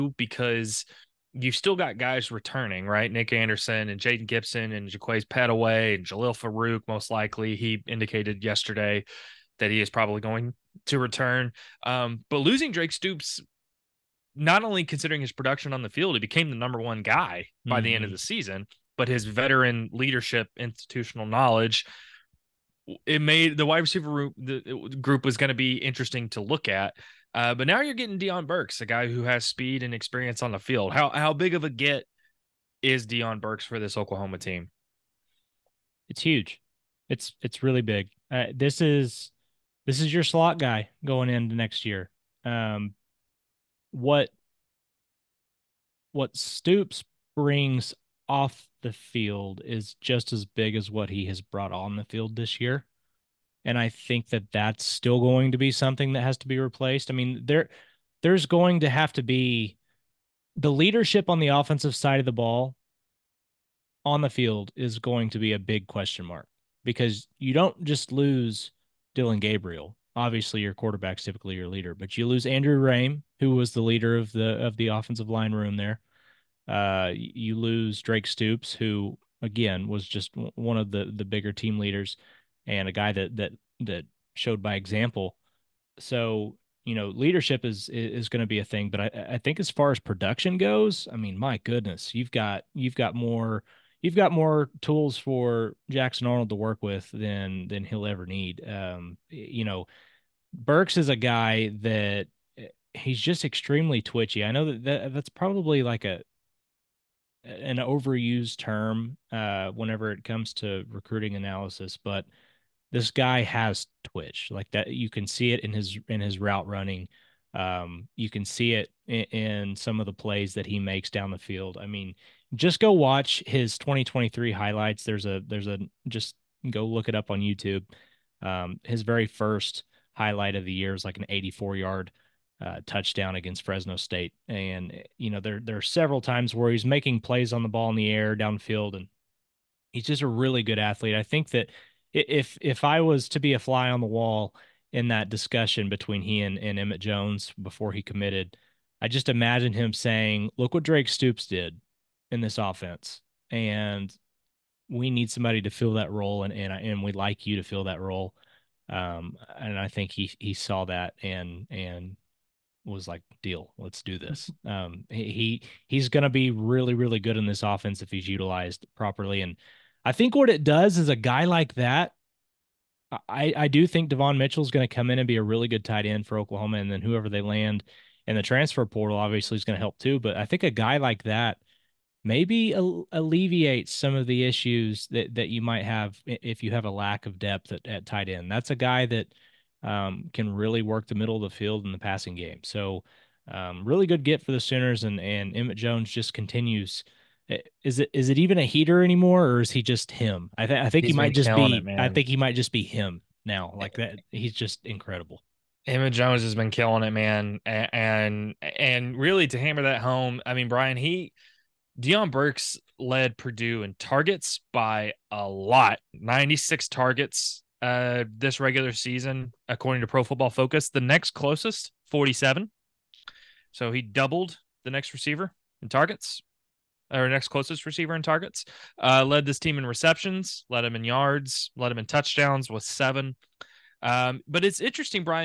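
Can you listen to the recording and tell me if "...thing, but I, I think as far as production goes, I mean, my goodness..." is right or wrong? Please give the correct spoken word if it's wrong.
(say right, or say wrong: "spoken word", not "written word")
right.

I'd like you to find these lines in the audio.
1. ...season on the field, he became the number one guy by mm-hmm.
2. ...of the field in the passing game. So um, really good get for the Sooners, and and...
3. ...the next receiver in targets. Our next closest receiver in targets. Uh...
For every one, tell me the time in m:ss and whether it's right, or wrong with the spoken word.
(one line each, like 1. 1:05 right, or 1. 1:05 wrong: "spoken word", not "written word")
1. 0:15 wrong: "production", not "season"
2. 3:11 right
3. 3:44 right.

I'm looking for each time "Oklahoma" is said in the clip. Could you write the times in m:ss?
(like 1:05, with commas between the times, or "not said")
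0:33, 2:56.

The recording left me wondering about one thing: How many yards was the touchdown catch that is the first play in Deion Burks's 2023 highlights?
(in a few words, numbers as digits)
84.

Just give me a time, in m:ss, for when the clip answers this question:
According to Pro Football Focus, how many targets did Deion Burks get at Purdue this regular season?
3:36.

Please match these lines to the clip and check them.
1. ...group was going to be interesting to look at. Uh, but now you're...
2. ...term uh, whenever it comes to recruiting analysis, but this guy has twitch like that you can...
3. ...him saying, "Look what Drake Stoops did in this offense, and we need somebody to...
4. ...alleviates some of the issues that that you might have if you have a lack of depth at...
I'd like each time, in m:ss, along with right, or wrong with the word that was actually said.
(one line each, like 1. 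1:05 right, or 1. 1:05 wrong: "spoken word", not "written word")
1. 0:25 right
2. 1:48 right
3. 2:29 right
4. 3:02 right.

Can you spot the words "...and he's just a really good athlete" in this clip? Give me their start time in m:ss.
2:18.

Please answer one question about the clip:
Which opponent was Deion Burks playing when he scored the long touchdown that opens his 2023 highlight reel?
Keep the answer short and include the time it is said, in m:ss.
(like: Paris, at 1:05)
Fresno State, at 2:13.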